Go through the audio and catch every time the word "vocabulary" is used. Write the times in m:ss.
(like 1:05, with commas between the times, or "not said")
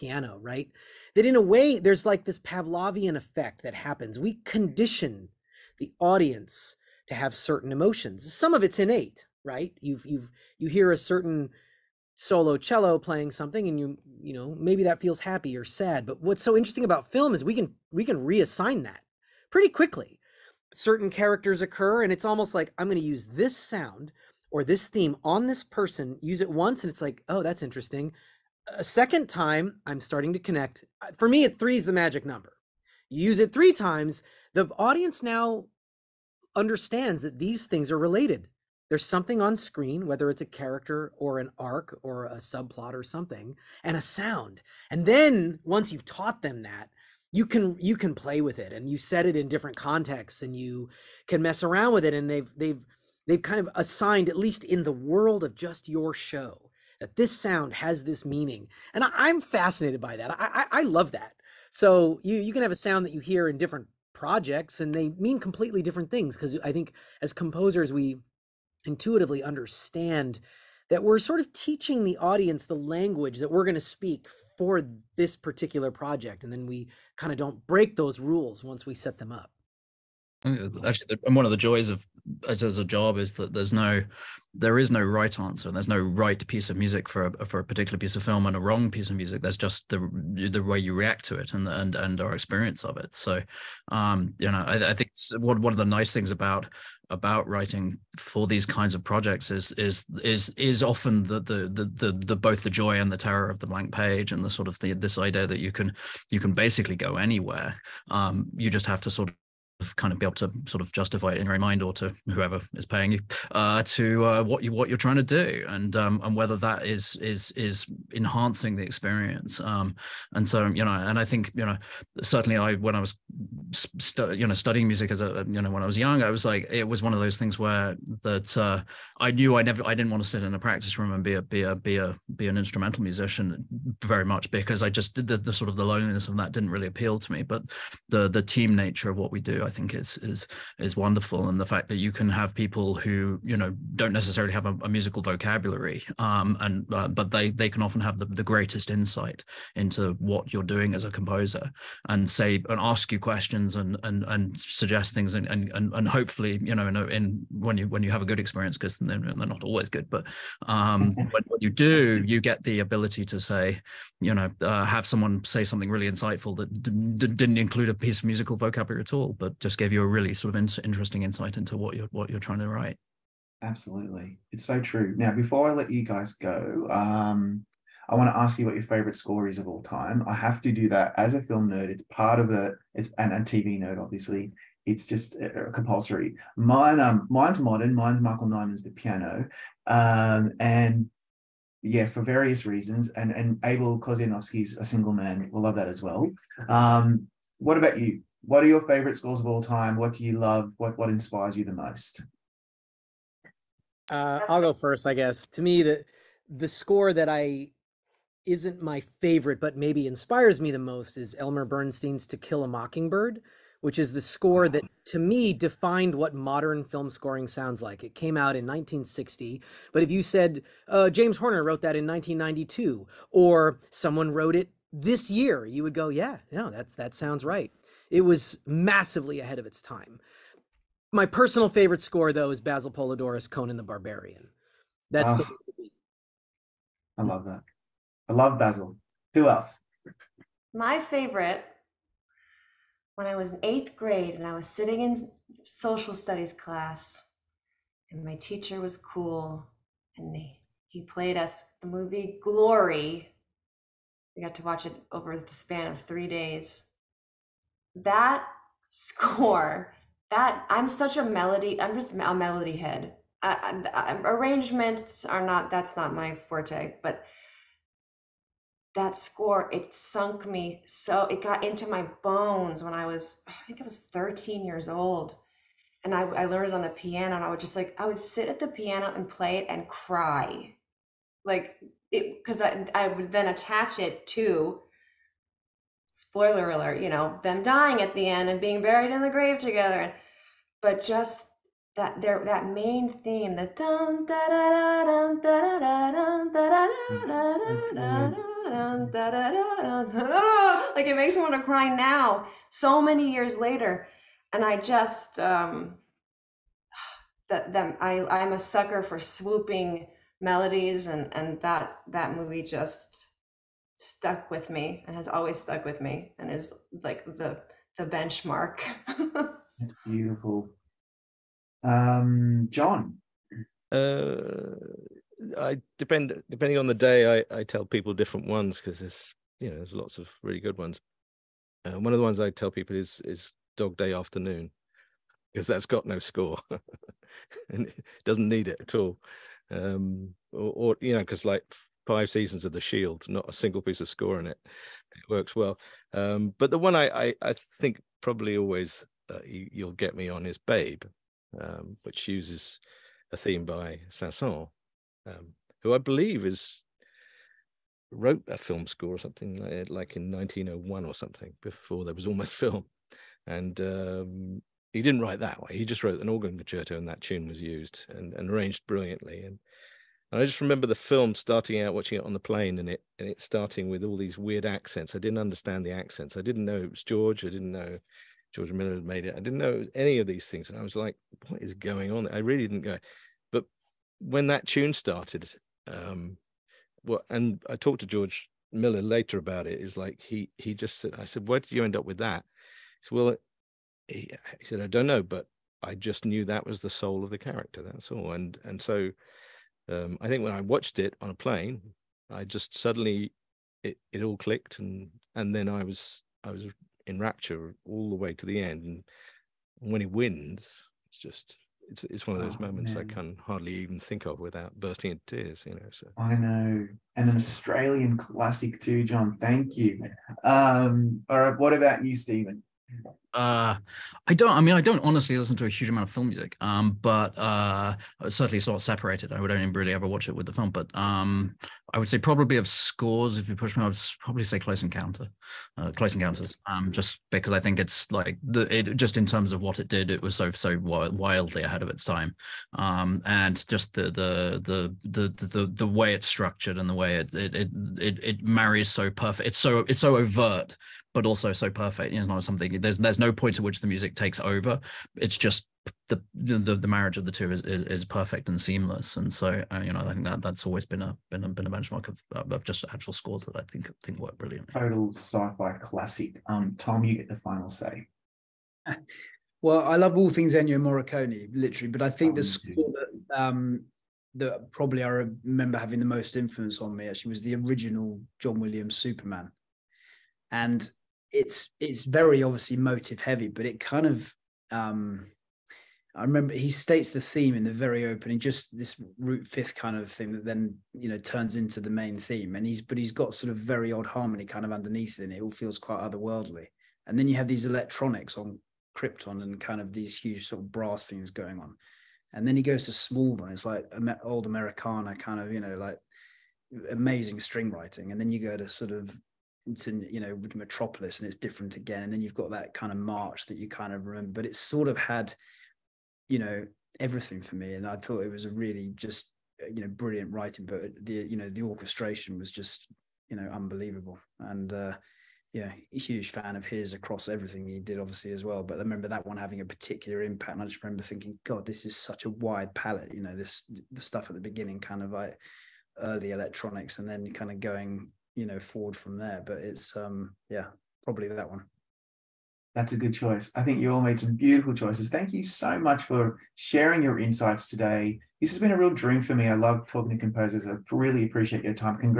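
2:25, 2:48.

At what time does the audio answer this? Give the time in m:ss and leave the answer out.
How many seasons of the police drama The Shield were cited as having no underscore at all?
5:42.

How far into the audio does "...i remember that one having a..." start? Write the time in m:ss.
8:48.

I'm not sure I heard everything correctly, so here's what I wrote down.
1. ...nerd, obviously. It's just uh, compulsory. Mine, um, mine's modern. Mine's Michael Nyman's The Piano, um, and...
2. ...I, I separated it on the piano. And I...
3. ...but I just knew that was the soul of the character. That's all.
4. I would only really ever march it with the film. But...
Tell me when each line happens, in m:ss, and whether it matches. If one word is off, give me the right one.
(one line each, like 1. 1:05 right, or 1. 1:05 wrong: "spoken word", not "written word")
1. 3:03 right
2. 4:36 wrong: "learned", not "separated"
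3. 6:35 right
4. 7:09 wrong: "watch", not "march".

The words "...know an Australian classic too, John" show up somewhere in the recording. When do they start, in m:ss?
6:56.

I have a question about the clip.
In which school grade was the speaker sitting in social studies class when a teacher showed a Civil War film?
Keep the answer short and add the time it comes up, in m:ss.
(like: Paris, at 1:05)
8th grade, at 4:03.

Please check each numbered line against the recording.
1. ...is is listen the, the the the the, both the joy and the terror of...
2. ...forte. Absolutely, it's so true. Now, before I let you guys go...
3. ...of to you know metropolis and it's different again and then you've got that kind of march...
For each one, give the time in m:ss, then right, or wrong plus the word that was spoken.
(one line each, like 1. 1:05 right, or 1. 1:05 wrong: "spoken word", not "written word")
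1. 1:40 wrong: "often", not "listen"
2. 2:52 wrong: "write", not "forte"
3. 8:28 right.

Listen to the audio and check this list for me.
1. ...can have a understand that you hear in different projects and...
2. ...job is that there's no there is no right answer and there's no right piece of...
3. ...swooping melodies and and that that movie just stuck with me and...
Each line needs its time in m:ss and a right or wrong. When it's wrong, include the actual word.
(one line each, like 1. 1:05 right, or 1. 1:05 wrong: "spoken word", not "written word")
1. 1:02 wrong: "sound", not "understand"
2. 1:22 right
3. 5:09 right.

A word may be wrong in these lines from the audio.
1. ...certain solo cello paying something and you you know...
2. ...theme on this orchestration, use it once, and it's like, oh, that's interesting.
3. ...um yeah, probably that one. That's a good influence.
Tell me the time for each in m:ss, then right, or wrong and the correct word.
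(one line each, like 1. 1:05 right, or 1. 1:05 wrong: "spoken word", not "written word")
1. 0:10 wrong: "playing", not "paying"
2. 0:24 wrong: "person", not "orchestration"
3. 8:59 wrong: "choice", not "influence".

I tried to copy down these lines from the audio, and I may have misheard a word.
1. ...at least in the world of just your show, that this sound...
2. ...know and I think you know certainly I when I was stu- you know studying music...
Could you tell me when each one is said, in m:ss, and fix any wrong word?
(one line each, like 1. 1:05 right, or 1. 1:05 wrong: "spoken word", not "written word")
1. 0:54 right
2. 2:00 right.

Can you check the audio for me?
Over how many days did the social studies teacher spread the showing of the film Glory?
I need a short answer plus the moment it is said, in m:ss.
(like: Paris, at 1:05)
3, at 4:15.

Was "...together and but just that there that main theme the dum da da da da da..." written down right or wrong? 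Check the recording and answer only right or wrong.
right.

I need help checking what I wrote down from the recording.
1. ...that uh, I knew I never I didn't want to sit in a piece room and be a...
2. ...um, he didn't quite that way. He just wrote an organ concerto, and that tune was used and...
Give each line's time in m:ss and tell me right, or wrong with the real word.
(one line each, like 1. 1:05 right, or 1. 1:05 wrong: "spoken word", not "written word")
1. 2:08 wrong: "practice", not "piece"
2. 6:03 wrong: "write", not "quite".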